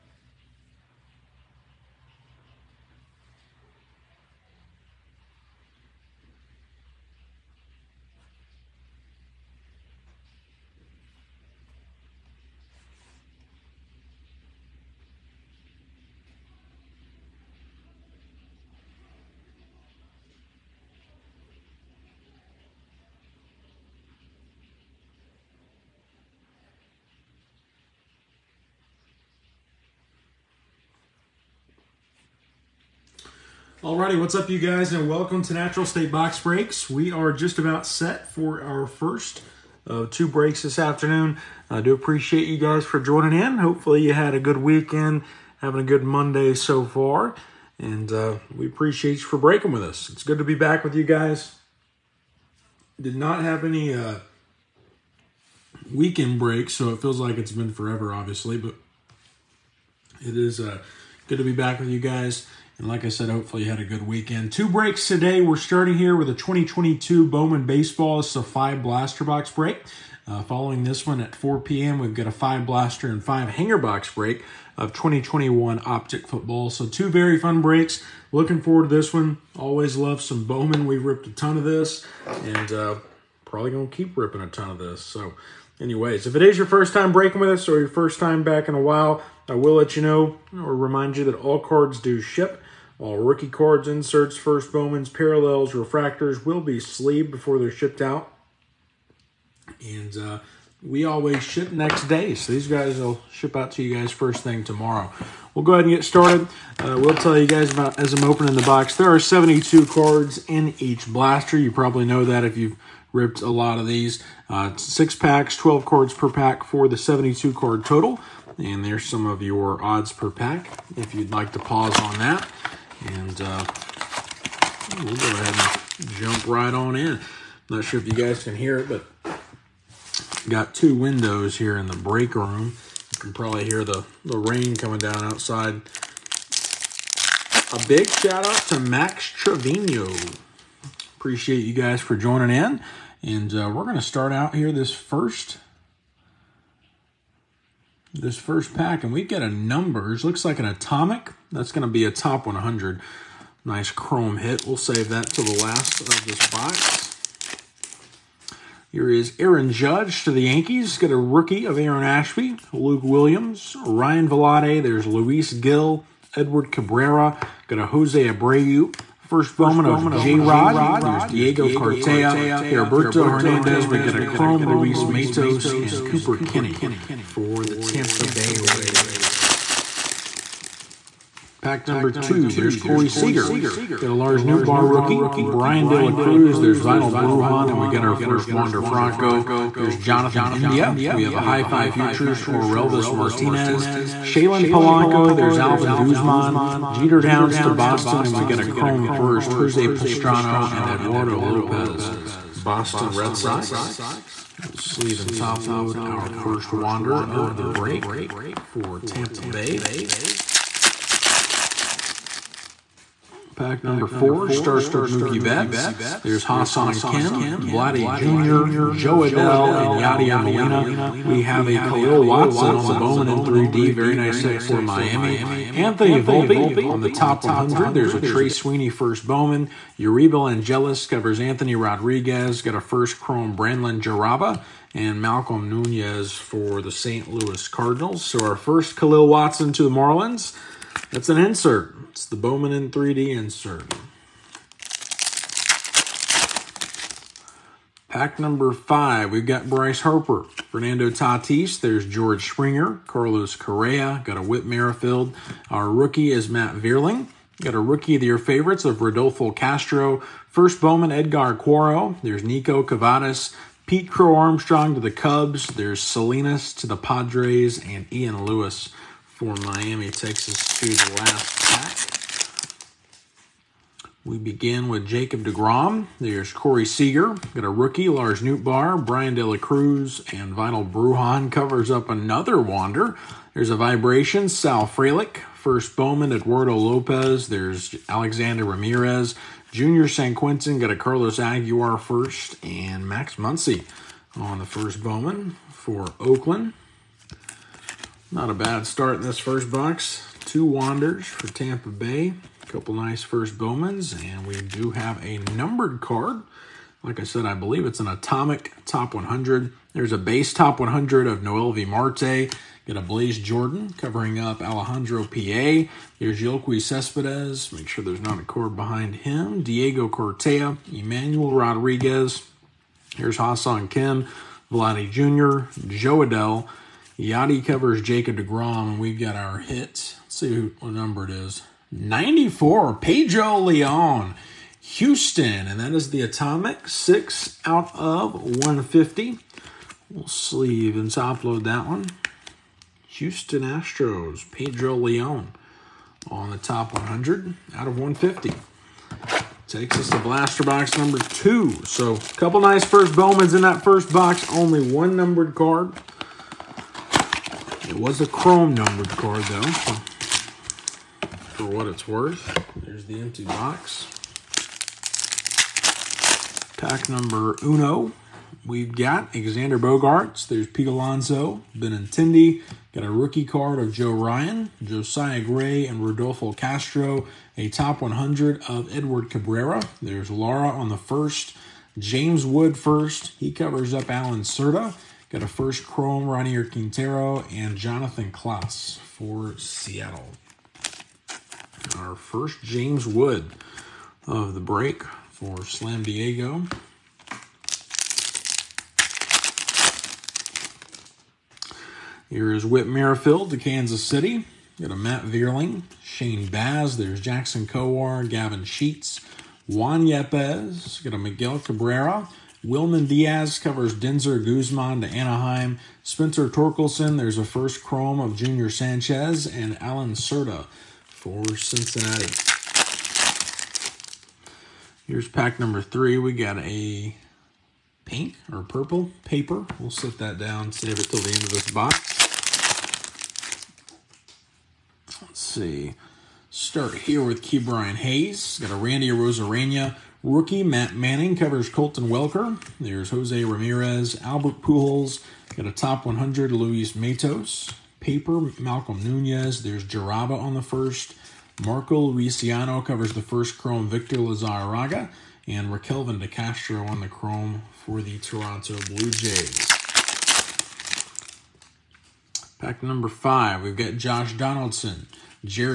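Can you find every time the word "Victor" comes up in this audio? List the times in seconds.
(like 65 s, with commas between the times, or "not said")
453 s.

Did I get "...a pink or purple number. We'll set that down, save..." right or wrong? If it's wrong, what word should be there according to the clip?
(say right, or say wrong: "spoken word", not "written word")
wrong: "paper", not "number".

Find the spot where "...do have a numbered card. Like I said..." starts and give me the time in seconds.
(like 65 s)
304 s.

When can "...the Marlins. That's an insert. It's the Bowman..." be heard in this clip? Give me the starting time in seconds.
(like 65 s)
239 s.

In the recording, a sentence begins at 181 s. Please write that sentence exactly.
Pack number two, there's Corey Seager.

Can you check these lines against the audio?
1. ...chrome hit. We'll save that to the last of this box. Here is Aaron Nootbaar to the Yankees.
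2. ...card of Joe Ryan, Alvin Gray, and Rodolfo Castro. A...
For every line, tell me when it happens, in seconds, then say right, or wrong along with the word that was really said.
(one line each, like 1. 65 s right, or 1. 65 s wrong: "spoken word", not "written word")
1. 153 s wrong: "Judge", not "Nootbaar"
2. 373 s wrong: "Josiah", not "Alvin".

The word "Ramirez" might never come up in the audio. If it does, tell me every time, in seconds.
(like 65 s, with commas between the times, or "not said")
288 s, 443 s.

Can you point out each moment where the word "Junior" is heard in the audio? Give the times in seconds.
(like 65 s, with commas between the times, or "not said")
289 s, 418 s.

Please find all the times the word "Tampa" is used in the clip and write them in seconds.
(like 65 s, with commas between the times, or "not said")
177 s, 208 s, 301 s.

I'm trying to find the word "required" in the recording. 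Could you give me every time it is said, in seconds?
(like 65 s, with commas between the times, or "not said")
not said.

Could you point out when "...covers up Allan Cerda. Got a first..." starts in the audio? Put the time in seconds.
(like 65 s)
383 s.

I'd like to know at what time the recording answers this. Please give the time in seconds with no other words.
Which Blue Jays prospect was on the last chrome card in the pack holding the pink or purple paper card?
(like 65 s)
455 s.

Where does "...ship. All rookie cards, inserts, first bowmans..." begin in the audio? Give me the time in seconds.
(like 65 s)
92 s.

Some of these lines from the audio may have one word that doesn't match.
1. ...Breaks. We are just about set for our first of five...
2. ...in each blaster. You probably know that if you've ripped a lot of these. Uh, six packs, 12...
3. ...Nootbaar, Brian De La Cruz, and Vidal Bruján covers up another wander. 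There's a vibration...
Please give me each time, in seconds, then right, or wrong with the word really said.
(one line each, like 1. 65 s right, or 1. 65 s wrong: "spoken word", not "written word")
1. 36 s wrong: "two", not "five"
2. 110 s right
3. 278 s right.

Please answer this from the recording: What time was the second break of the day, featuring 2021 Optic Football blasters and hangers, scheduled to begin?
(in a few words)
4 p.m.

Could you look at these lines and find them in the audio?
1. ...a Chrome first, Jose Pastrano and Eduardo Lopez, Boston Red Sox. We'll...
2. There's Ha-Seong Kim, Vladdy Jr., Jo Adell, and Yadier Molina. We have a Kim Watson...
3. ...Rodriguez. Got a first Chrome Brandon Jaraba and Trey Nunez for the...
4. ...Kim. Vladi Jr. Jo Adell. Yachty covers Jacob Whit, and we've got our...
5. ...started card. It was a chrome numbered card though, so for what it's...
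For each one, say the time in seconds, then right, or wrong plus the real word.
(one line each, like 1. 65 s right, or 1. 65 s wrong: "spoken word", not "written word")
1. 198 s right
2. 216 s wrong: "Khalil", not "Kim"
3. 231 s wrong: "Malcolm", not "Trey"
4. 323 s wrong: "DeGrom", not "Whit"
5. 355 s wrong: "numbered", not "started".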